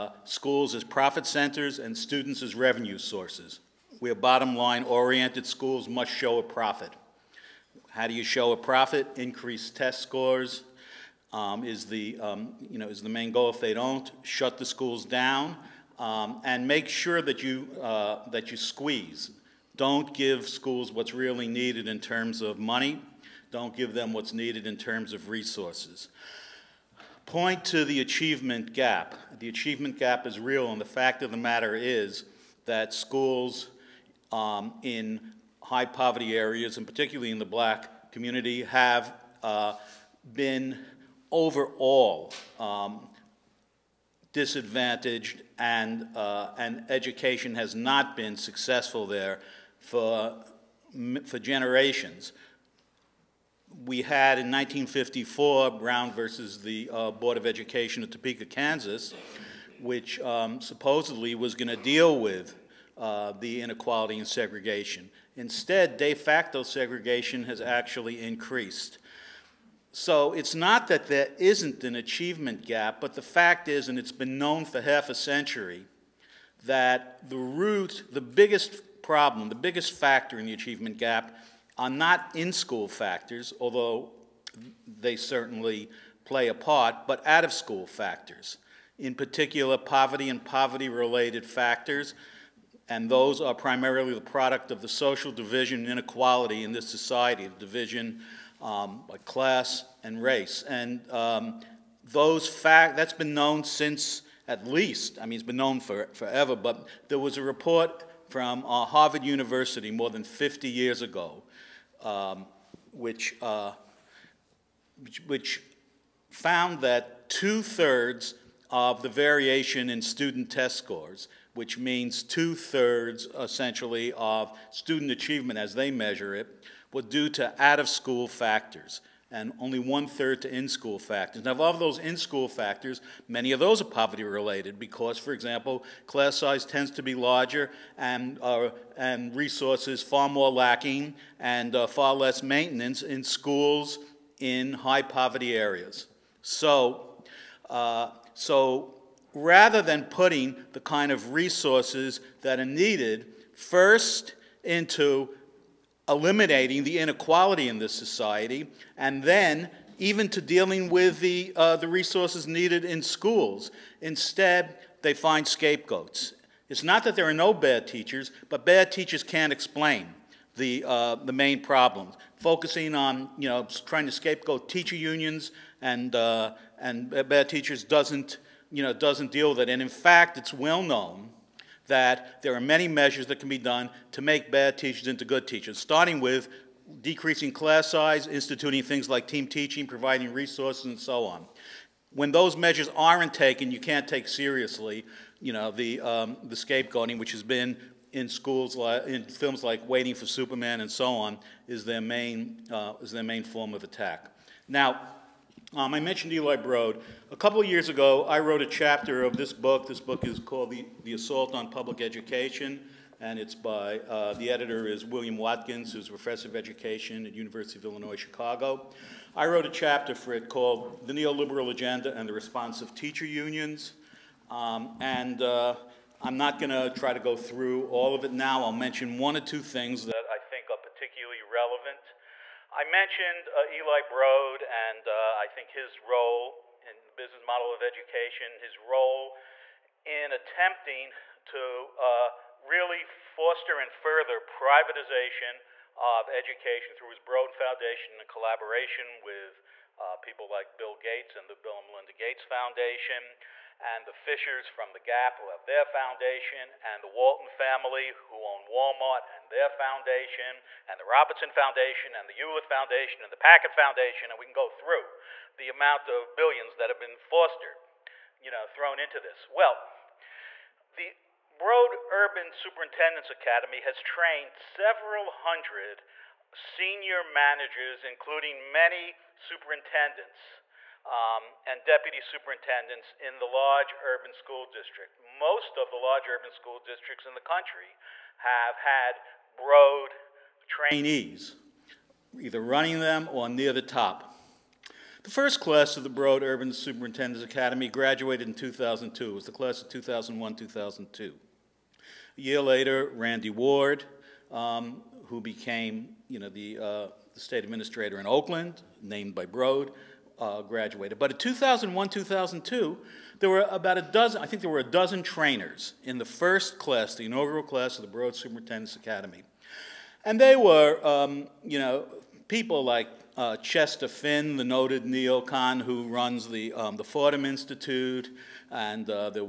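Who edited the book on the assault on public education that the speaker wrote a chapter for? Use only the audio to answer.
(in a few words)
William Watkins.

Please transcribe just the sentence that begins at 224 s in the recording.
Um, and uh, I'm not going to try to go through all of it now.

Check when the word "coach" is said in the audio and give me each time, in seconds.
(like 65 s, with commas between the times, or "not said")
not said.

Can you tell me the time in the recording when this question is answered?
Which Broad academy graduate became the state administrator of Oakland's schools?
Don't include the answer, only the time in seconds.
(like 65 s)
303 s.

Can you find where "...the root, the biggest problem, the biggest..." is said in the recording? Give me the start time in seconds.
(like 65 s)
77 s.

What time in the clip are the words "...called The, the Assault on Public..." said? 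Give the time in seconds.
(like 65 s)
210 s.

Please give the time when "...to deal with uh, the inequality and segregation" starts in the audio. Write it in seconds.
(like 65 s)
61 s.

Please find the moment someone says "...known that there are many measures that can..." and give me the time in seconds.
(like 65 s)
180 s.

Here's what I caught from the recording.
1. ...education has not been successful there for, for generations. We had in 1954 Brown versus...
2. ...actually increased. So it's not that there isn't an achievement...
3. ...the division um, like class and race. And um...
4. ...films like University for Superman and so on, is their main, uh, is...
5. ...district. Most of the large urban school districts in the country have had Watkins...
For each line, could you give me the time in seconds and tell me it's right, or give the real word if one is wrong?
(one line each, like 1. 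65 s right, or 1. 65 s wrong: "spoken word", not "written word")
1. 46 s right
2. 67 s right
3. 97 s right
4. 199 s wrong: "Waiting", not "University"
5. 284 s wrong: "Broad", not "Watkins".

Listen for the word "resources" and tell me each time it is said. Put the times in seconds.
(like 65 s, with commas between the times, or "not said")
25 s, 139 s, 151 s, 161 s, 190 s.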